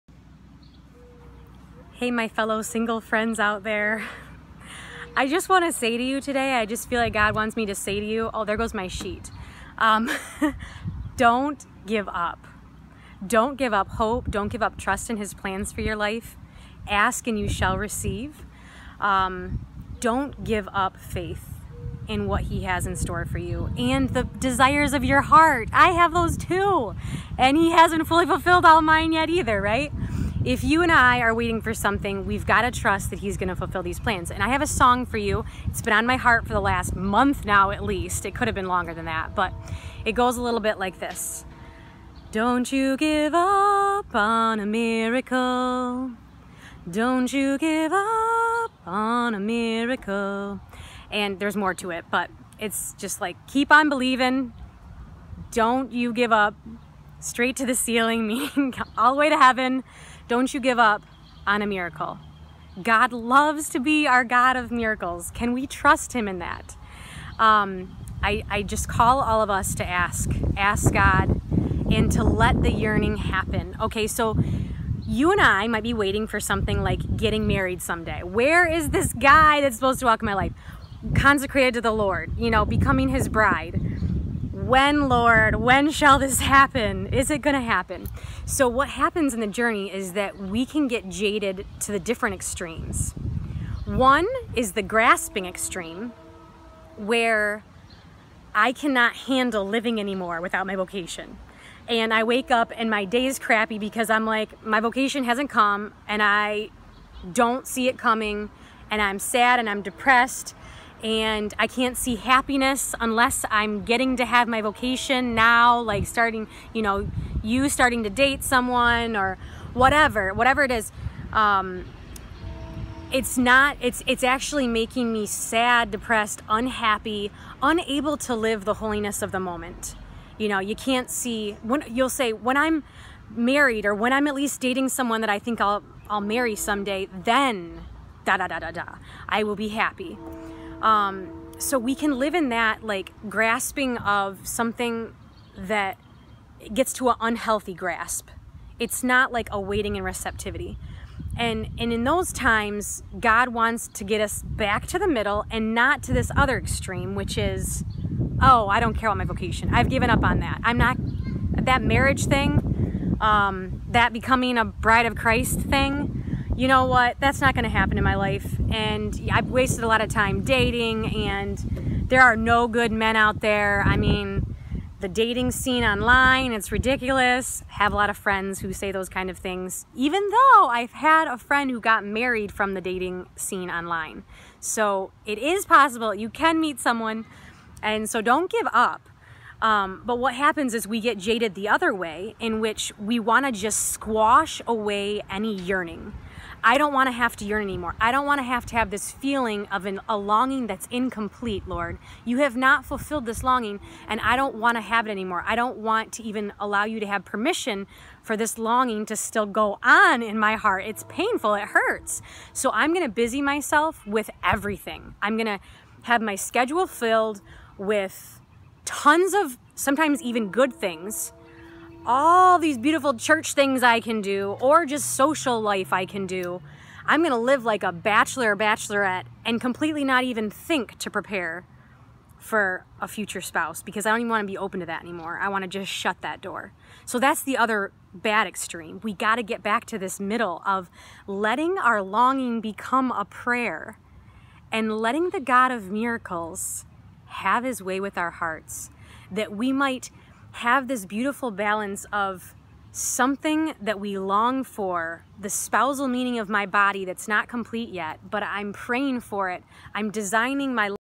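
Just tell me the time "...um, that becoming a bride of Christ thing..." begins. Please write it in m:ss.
2:43.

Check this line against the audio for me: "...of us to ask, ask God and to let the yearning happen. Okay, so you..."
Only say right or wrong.
right.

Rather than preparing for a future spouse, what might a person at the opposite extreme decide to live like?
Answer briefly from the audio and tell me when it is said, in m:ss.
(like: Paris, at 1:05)
bachelor or bachelorette, at 3:47.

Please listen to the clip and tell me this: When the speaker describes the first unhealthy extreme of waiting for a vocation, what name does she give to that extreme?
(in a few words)
grasping extreme.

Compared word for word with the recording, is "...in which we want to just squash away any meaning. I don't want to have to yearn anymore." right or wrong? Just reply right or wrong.
wrong.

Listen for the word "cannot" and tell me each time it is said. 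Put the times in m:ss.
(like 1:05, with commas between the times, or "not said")
1:38.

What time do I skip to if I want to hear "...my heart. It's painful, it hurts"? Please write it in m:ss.
3:30.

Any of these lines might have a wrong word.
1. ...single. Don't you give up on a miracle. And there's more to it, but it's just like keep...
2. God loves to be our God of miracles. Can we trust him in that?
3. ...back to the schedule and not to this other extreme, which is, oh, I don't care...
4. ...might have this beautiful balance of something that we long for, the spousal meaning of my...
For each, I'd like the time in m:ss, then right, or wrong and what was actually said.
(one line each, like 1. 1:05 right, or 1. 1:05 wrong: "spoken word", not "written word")
1. 0:44 wrong: "miracle", not "single"
2. 1:02 right
3. 2:34 wrong: "middle", not "schedule"
4. 4:09 right.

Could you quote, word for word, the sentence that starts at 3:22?
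You have not fulfilled this longing, and I don't want to have it anymore.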